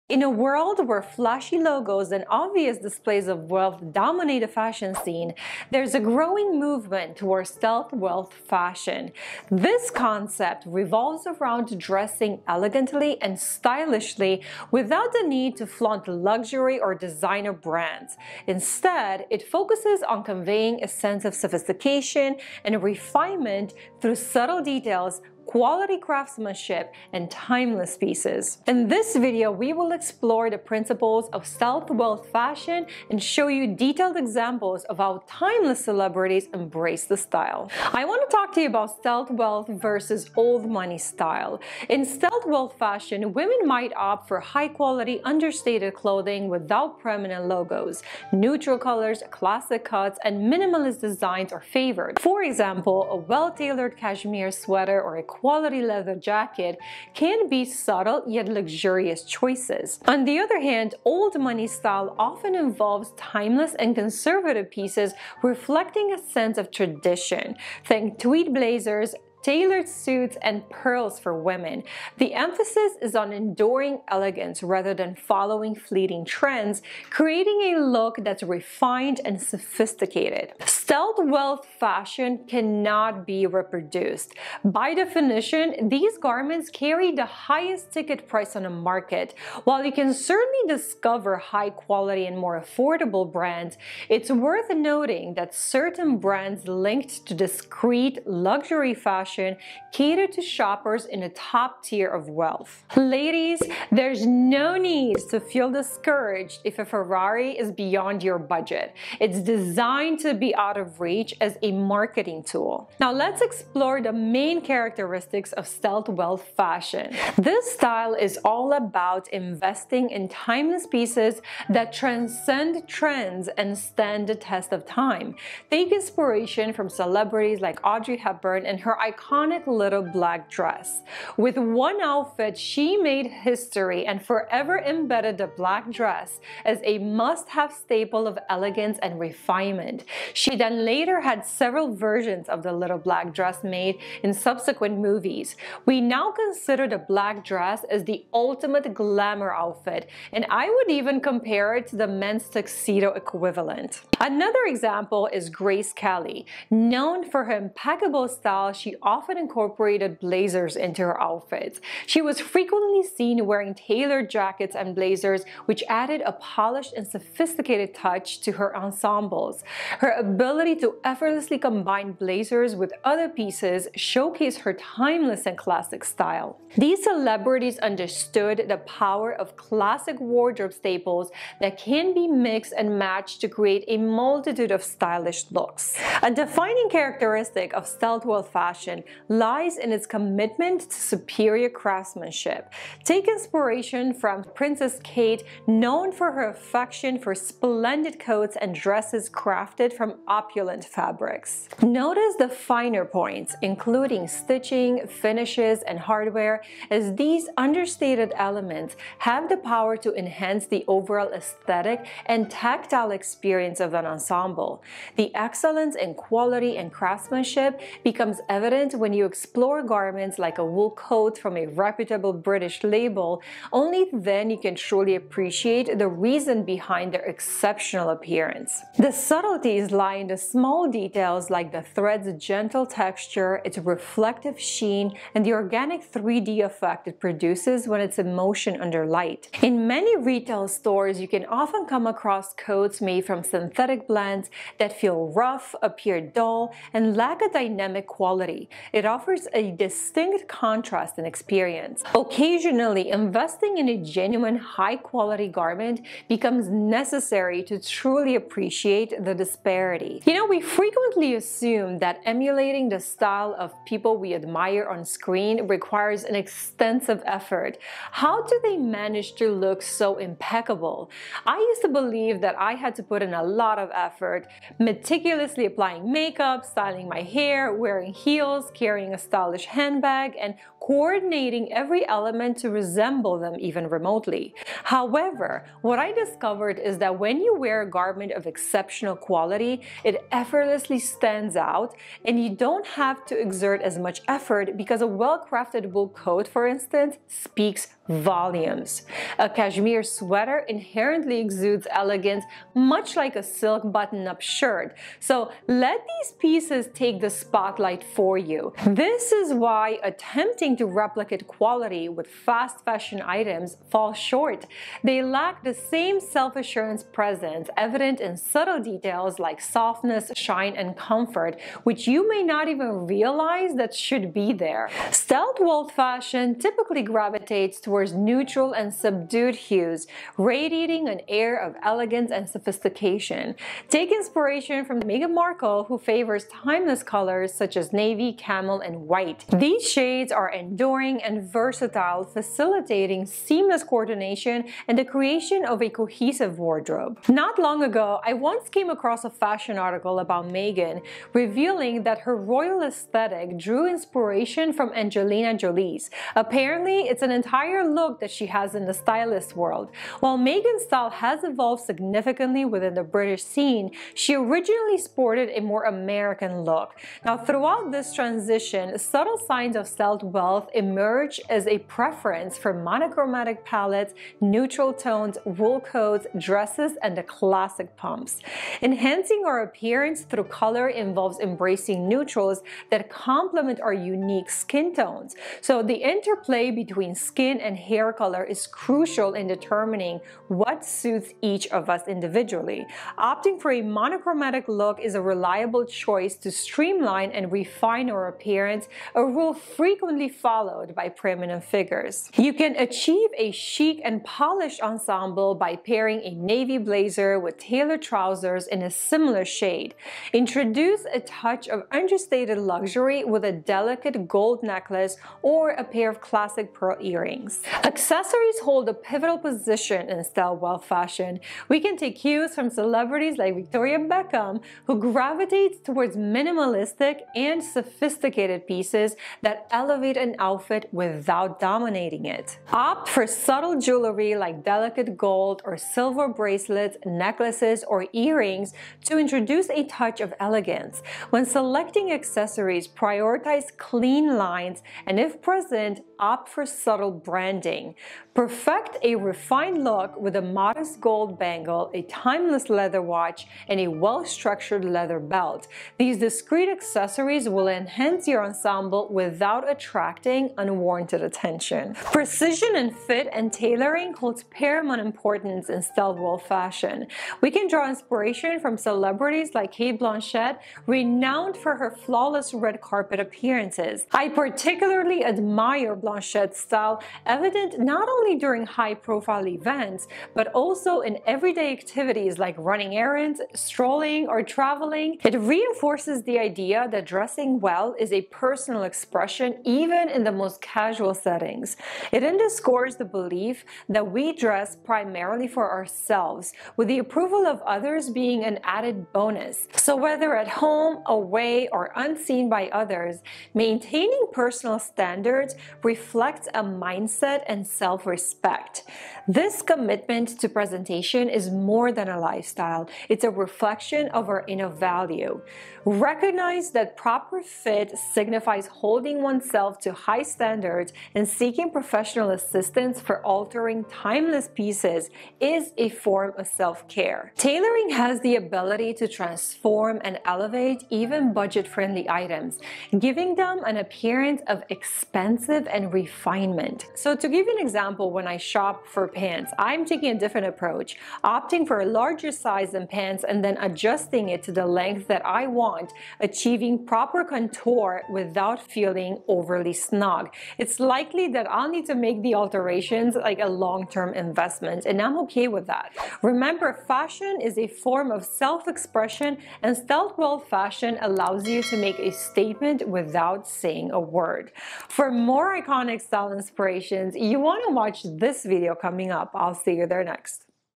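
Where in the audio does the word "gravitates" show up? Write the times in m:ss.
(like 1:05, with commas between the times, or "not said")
5:27, 7:04.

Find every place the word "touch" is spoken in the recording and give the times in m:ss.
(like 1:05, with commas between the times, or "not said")
2:47, 6:51, 7:19.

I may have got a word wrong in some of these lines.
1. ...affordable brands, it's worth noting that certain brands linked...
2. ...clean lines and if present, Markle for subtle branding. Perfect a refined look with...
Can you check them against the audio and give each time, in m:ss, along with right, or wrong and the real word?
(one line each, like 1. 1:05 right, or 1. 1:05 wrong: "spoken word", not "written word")
1. 1:32 right
2. 7:23 wrong: "Opt", not "Markle".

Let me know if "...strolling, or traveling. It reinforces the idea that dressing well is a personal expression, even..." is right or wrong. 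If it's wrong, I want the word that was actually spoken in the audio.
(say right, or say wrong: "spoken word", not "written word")
right.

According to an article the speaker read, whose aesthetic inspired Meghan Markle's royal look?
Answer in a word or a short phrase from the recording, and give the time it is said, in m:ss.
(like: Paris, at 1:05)
Angelina Jolie, at 5:54.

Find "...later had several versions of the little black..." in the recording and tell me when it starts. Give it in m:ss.
2:20.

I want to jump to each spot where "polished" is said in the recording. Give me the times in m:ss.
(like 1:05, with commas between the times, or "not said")
2:46, 6:44.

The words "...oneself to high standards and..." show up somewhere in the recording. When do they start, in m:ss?
8:39.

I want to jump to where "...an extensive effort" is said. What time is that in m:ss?
4:26.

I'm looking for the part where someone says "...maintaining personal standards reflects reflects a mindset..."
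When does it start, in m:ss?
8:23.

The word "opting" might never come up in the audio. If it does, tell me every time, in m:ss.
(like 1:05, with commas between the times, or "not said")
6:33, 9:01.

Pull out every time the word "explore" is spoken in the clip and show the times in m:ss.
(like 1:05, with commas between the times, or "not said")
0:29, 1:53, 3:39.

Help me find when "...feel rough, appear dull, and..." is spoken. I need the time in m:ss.
4:04.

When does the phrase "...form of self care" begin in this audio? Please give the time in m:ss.
8:45.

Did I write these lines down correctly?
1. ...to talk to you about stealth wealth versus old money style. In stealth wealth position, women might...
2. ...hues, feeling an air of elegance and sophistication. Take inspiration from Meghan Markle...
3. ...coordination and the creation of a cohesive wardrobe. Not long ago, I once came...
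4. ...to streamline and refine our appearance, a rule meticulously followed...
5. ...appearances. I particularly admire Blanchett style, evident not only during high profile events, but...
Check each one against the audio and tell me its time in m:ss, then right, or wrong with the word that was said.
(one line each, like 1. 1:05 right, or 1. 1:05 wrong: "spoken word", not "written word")
1. 0:38 wrong: "fashion", not "position"
2. 5:29 wrong: "radiating", not "feeling"
3. 5:43 right
4. 6:36 wrong: "frequently", not "meticulously"
5. 7:53 right.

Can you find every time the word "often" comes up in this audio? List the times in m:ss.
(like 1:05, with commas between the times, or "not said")
1:02, 2:39, 4:01.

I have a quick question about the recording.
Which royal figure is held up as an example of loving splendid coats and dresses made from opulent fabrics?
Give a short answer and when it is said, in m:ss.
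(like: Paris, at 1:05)
Princess Kate, at 3:14.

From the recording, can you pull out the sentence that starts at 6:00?
While Meghan's style has evolved significantly within the British scene, she originally sported a more American look.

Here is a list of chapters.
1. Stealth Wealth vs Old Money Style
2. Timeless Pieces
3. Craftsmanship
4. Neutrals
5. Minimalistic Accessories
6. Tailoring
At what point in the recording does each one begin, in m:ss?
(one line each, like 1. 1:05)
1. 0:38
2. 1:57
3. 3:06
4. 5:26
5. 6:58
6. 7:42.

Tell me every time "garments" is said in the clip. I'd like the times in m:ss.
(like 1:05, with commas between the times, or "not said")
1:26, 3:39, 4:15, 4:47.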